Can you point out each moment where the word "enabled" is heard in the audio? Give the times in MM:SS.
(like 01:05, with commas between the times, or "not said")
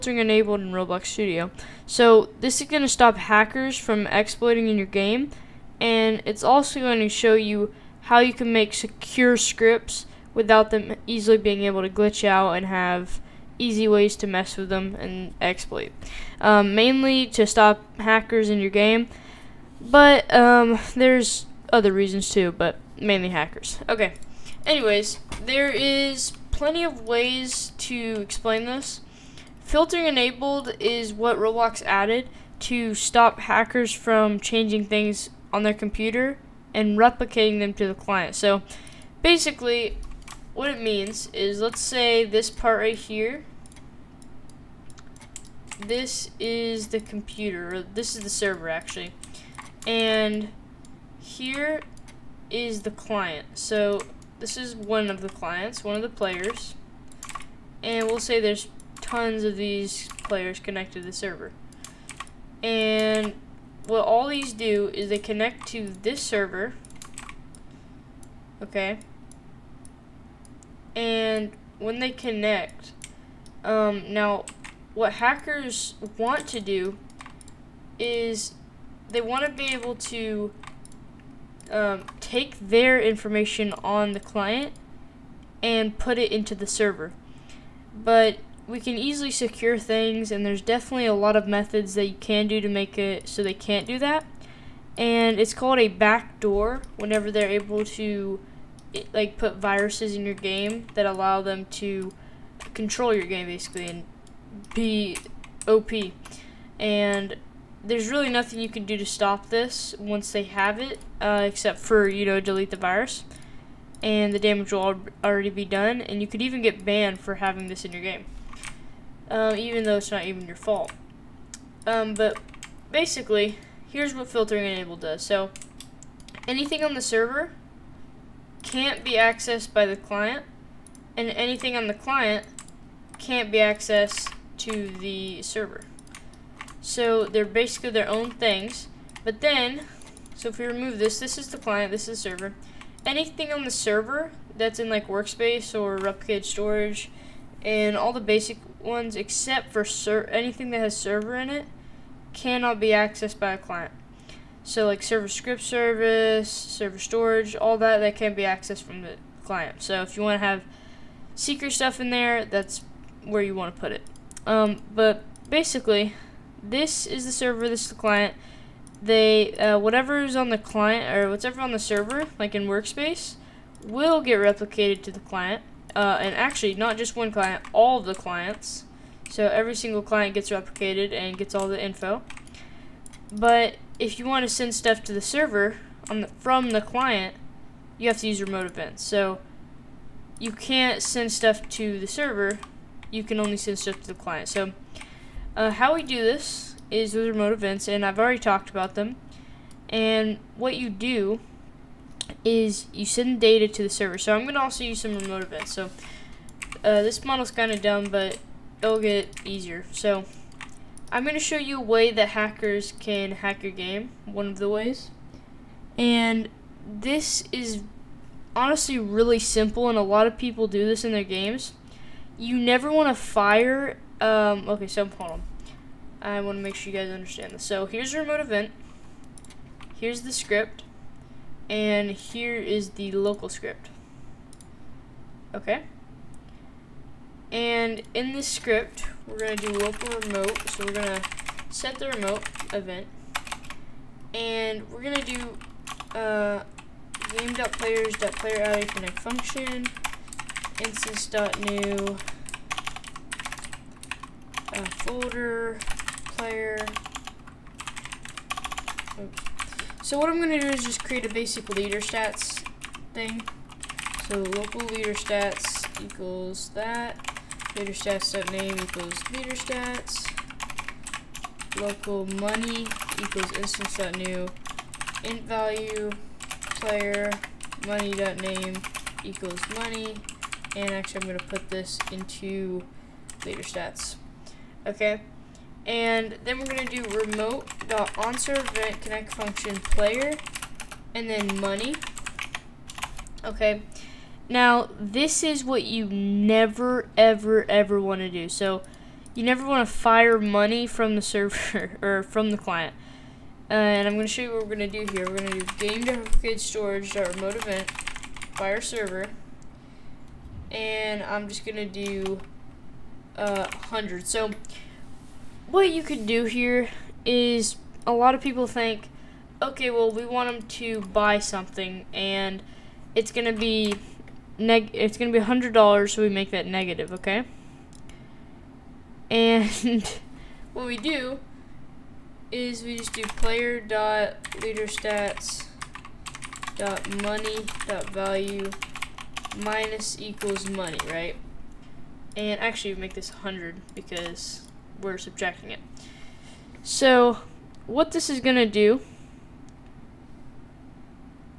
00:00, 00:30, 02:04.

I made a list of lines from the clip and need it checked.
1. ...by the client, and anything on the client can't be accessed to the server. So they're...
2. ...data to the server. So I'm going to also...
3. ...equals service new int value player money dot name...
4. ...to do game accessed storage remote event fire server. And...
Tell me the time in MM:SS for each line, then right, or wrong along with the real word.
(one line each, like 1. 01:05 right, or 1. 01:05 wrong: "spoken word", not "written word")
1. 02:09 right
2. 03:23 right
3. 04:33 wrong: "instance", not "service"
4. 05:05 wrong: "replicated", not "accessed".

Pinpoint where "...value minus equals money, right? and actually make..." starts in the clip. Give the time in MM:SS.
05:38.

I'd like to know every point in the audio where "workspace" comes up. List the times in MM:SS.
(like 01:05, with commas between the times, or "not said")
02:25, 02:52.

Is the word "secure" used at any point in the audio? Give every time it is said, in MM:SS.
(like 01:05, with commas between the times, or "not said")
00:08, 01:29.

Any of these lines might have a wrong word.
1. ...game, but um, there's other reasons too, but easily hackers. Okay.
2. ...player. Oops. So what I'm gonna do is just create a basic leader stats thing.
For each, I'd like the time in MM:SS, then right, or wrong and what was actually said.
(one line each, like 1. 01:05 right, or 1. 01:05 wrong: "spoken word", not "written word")
1. 00:18 wrong: "mainly", not "easily"
2. 04:16 right.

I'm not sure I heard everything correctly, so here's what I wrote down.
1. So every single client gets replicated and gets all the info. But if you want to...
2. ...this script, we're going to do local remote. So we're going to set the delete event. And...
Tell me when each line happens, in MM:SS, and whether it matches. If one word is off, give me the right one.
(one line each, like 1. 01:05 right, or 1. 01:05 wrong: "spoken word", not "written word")
1. 02:59 right
2. 03:58 wrong: "remote", not "delete".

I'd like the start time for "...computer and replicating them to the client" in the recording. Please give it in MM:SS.
00:35.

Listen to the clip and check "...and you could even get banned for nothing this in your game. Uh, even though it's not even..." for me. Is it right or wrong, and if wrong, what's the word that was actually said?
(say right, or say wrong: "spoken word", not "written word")
wrong: "having", not "nothing".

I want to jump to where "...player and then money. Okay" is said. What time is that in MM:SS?
04:49.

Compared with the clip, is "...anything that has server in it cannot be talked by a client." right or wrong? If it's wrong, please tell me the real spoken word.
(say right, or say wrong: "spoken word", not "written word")
wrong: "accessed", not "talked".